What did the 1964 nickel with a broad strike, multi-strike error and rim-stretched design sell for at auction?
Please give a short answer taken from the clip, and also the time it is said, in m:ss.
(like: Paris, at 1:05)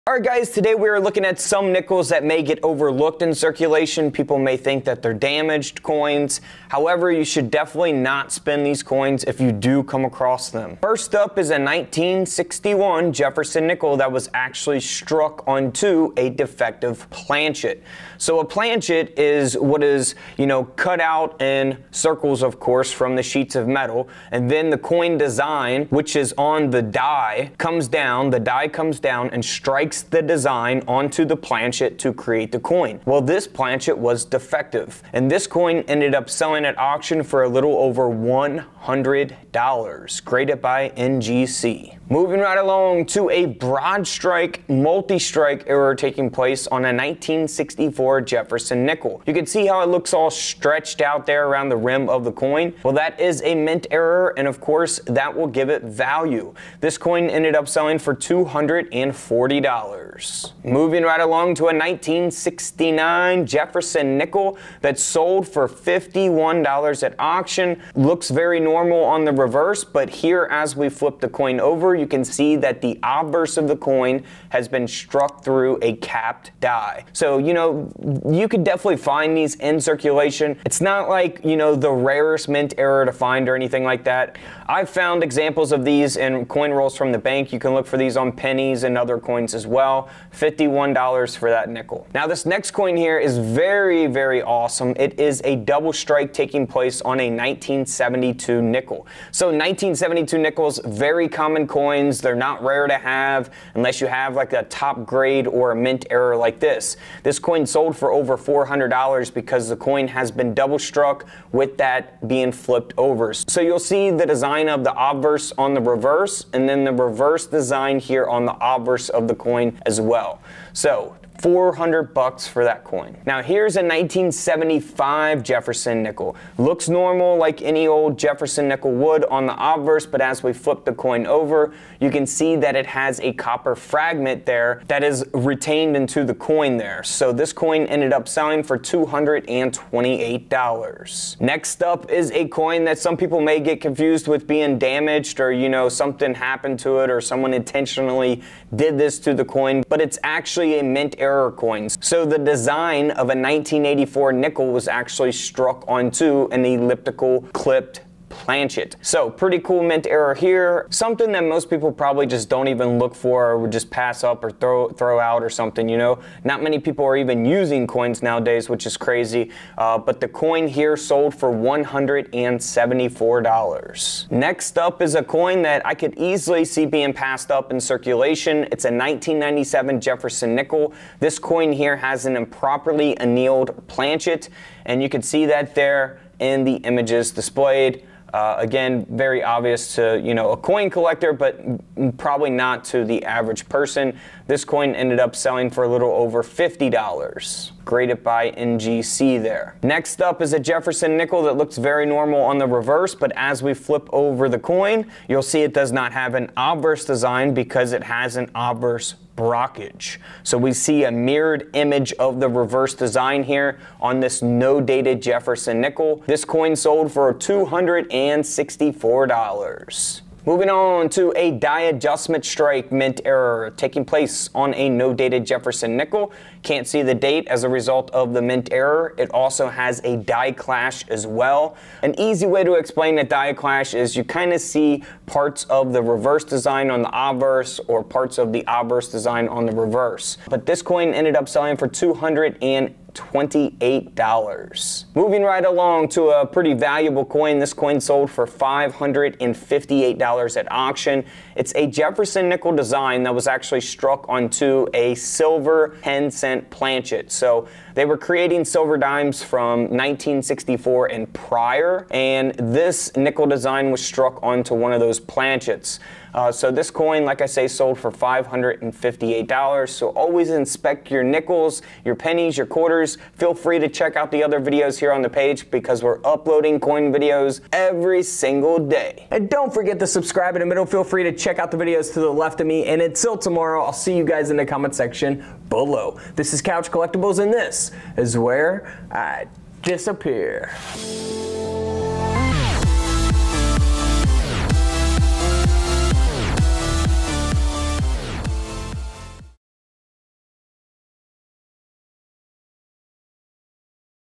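$240, at 0:58.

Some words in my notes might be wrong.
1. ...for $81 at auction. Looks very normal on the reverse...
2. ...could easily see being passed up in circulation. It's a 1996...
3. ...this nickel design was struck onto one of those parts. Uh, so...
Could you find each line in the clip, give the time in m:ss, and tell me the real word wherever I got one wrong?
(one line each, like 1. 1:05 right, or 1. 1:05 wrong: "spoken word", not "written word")
1. 1:05 wrong: "51", not "81"
2. 2:55 wrong: "1997", not "1996"
3. 4:22 wrong: "planchets", not "parts".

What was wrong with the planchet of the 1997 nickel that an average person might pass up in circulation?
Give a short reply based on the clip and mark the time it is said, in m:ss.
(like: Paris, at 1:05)
Improperly annealed, at 3:02.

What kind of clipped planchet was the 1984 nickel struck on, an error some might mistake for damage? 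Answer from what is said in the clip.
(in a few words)
Elliptical.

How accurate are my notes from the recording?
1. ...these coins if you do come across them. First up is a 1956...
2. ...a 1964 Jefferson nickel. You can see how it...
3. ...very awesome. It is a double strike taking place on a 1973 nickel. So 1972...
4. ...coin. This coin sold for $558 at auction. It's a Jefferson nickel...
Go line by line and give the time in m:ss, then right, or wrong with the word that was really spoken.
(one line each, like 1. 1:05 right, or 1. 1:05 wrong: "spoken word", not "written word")
1. 0:08 wrong: "1961", not "1956"
2. 0:46 right
3. 1:34 wrong: "1972", not "1973"
4. 4:07 right.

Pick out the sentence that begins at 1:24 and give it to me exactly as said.
I've found examples of these in coin rolls from the bank.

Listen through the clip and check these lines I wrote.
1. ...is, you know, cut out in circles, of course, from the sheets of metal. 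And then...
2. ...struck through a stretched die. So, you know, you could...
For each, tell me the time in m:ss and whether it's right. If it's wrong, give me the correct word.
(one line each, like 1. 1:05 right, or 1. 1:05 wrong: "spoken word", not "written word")
1. 0:19 right
2. 1:14 wrong: "capped", not "stretched".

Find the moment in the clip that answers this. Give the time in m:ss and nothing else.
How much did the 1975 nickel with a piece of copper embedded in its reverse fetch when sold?
2:18.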